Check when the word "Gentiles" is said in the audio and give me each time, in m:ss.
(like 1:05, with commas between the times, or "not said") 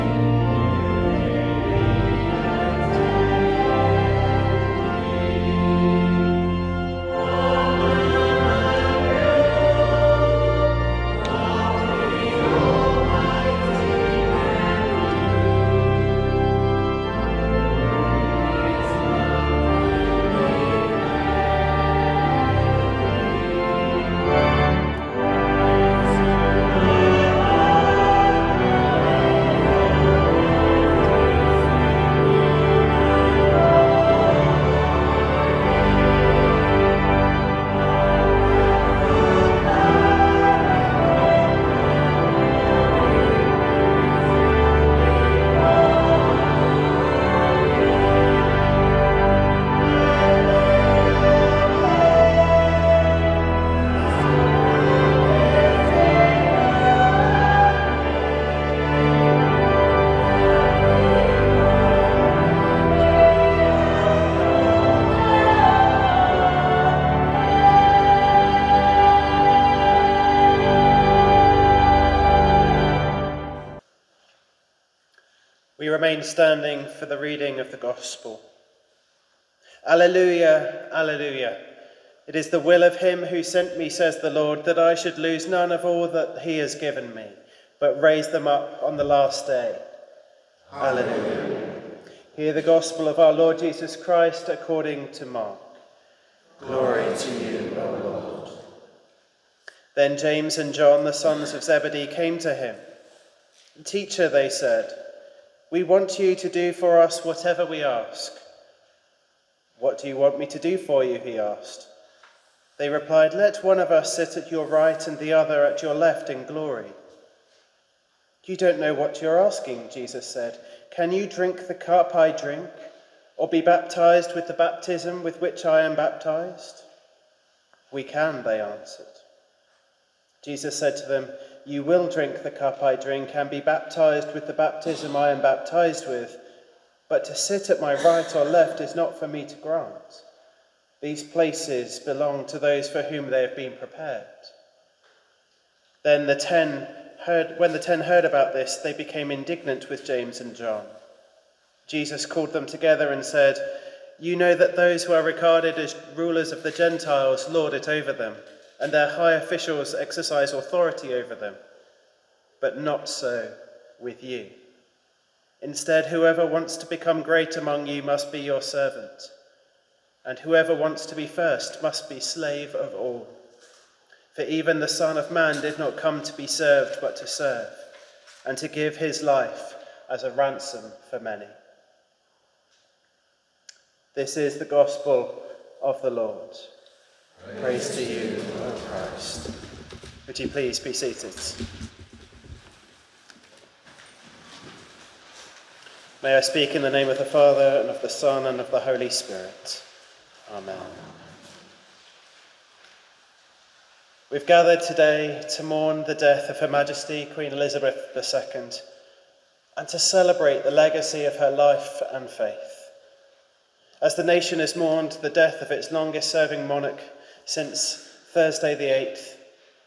2:36.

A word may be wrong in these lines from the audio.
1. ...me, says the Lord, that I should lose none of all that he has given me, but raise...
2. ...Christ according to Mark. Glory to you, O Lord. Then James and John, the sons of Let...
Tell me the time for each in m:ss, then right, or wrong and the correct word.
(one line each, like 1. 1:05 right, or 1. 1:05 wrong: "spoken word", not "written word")
1. 1:23 right
2. 1:33 wrong: "Zebedee", not "Let".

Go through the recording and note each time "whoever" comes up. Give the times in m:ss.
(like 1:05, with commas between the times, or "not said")
2:46, 2:50.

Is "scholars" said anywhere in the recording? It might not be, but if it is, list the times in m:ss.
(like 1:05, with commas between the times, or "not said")
not said.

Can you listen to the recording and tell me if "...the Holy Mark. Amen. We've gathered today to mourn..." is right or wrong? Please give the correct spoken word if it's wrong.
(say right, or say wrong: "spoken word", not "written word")
wrong: "Spirit", not "Mark".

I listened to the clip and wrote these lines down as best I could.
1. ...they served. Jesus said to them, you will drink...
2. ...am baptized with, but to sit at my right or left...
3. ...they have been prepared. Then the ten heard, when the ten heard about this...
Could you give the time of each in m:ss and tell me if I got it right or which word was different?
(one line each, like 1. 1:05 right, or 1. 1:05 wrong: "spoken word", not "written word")
1. 2:08 wrong: "answered", not "served"
2. 2:15 right
3. 2:23 right.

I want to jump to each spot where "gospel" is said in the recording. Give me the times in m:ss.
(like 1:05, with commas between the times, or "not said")
1:17, 1:32, 3:04.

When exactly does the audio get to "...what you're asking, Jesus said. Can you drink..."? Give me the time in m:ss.
1:58.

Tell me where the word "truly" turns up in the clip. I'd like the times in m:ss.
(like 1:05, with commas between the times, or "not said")
not said.